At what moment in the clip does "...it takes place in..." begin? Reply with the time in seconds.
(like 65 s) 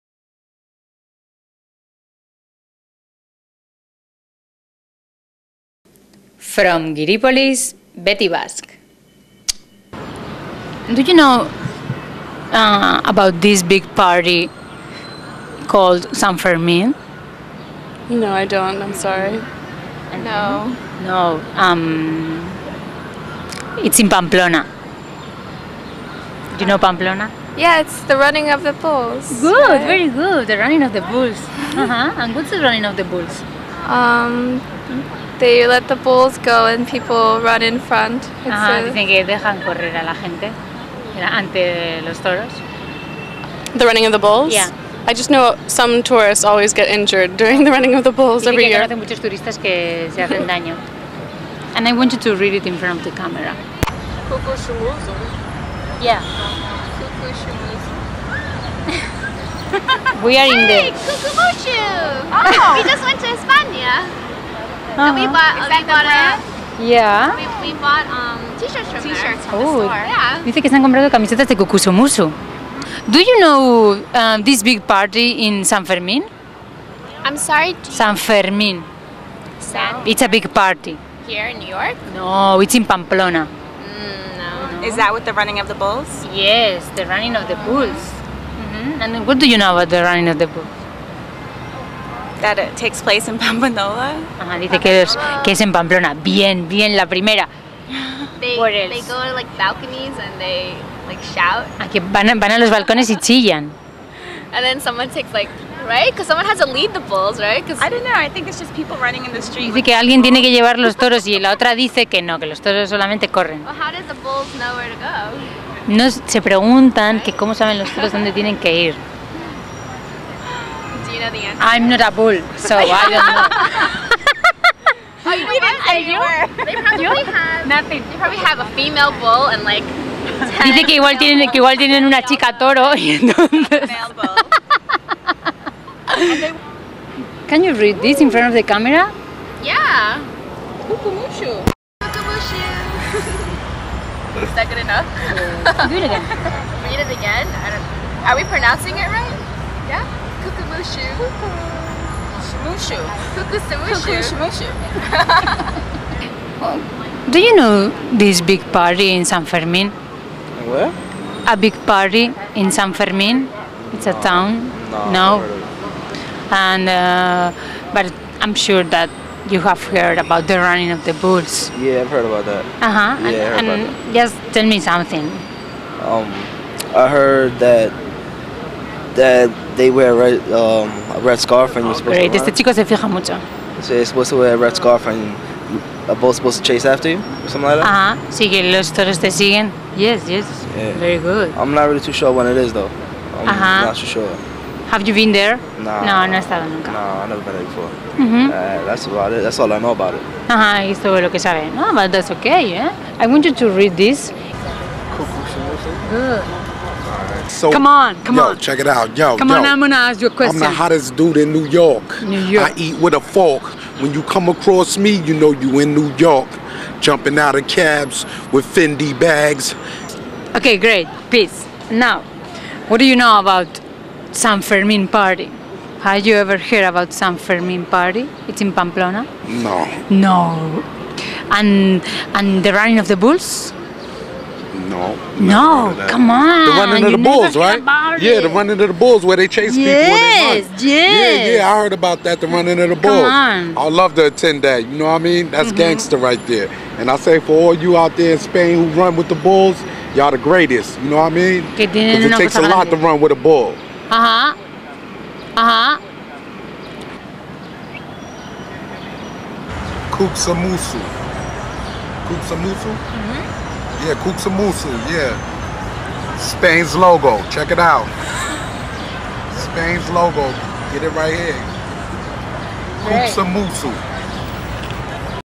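92 s.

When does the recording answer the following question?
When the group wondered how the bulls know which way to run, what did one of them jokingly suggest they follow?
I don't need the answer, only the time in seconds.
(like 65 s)
128 s.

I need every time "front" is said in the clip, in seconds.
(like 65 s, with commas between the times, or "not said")
37 s, 52 s, 138 s.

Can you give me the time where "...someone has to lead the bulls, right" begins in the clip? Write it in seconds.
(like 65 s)
106 s.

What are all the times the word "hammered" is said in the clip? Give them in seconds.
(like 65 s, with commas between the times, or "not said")
not said.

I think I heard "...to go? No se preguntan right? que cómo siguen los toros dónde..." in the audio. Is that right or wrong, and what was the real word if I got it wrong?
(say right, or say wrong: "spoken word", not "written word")
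wrong: "saben", not "siguen".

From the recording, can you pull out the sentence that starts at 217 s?
Jumping out of cabs with Fendi bags.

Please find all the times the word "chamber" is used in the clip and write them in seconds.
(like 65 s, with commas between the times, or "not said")
not said.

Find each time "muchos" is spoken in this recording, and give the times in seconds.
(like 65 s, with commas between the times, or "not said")
48 s, 183 s.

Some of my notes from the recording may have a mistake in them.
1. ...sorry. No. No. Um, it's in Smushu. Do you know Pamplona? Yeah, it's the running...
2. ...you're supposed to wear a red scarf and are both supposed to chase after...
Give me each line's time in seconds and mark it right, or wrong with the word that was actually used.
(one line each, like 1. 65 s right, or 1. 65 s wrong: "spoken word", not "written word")
1. 18 s wrong: "Pamplona", not "Smushu"
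2. 183 s right.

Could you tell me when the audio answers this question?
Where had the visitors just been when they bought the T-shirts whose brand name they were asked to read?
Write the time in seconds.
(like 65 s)
63 s.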